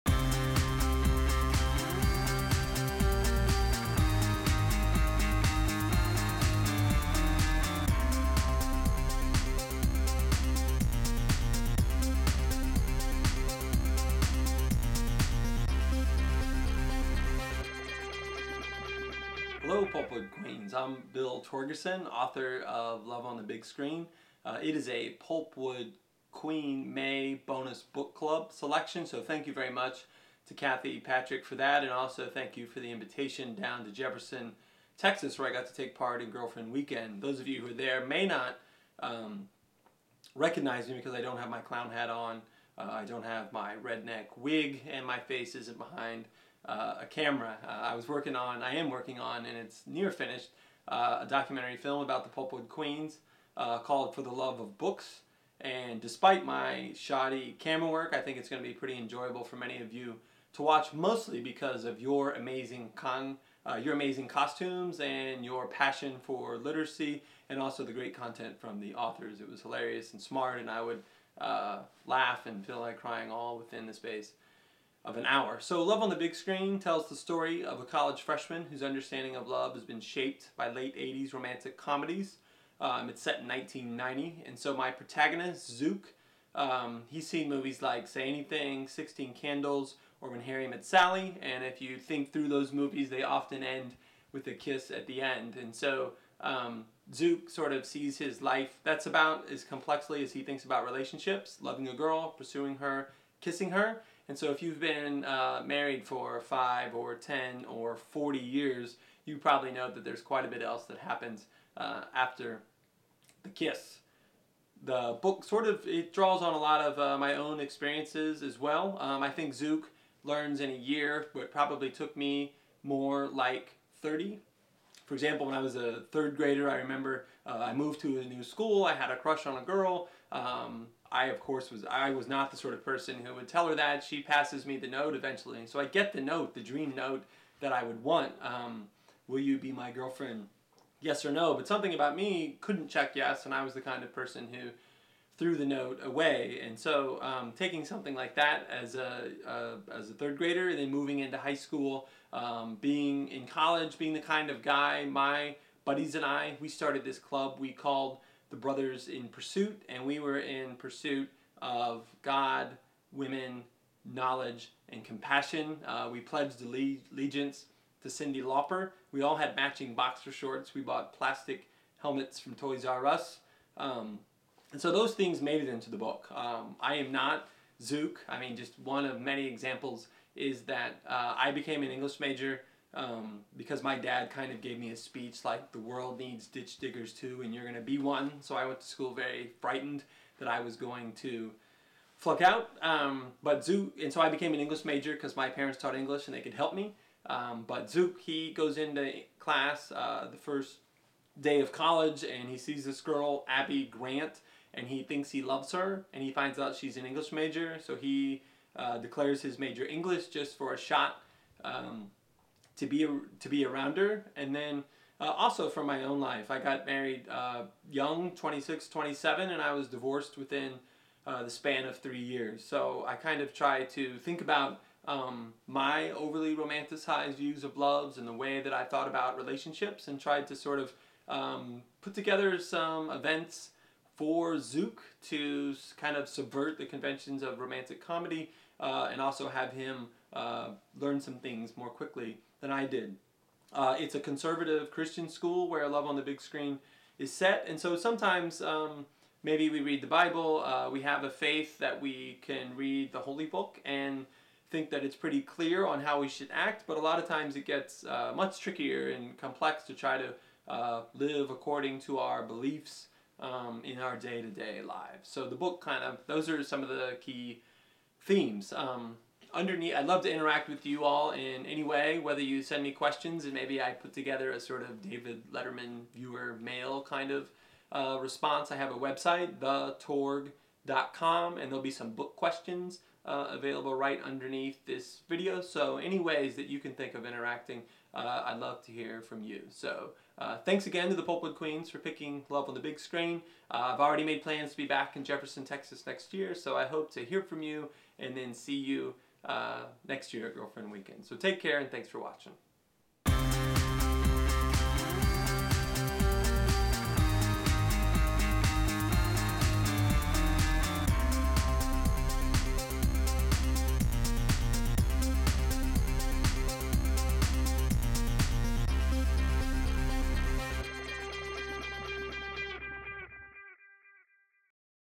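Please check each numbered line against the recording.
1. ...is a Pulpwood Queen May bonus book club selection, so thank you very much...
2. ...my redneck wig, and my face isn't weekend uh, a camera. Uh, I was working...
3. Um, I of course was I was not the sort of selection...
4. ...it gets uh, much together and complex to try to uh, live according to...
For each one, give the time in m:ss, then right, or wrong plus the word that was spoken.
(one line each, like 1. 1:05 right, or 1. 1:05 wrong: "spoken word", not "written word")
1. 0:24 right
2. 0:43 wrong: "behind", not "weekend"
3. 2:10 wrong: "person", not "selection"
4. 4:17 wrong: "trickier", not "together".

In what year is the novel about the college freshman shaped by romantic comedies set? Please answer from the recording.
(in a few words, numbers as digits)
1990.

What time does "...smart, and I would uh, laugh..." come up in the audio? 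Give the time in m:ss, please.
1:10.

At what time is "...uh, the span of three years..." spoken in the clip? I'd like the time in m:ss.
3:41.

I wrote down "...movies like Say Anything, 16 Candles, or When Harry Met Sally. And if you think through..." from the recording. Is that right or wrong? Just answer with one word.
right.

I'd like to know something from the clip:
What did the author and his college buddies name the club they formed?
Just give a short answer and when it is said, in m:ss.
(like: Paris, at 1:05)
The Brothers in Pursuit, at 2:38.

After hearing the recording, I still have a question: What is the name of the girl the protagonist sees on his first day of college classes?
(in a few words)
Abby Grant.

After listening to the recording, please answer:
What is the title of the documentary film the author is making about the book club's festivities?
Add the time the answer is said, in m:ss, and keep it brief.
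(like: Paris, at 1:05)
For the Love of Books, at 0:54.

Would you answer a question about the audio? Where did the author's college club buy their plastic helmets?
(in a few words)
Toys R Us.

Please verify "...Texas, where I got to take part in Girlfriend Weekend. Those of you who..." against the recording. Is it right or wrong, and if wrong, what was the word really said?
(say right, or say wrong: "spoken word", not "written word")
right.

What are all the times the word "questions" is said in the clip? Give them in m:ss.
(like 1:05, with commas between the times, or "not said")
4:32, 4:42.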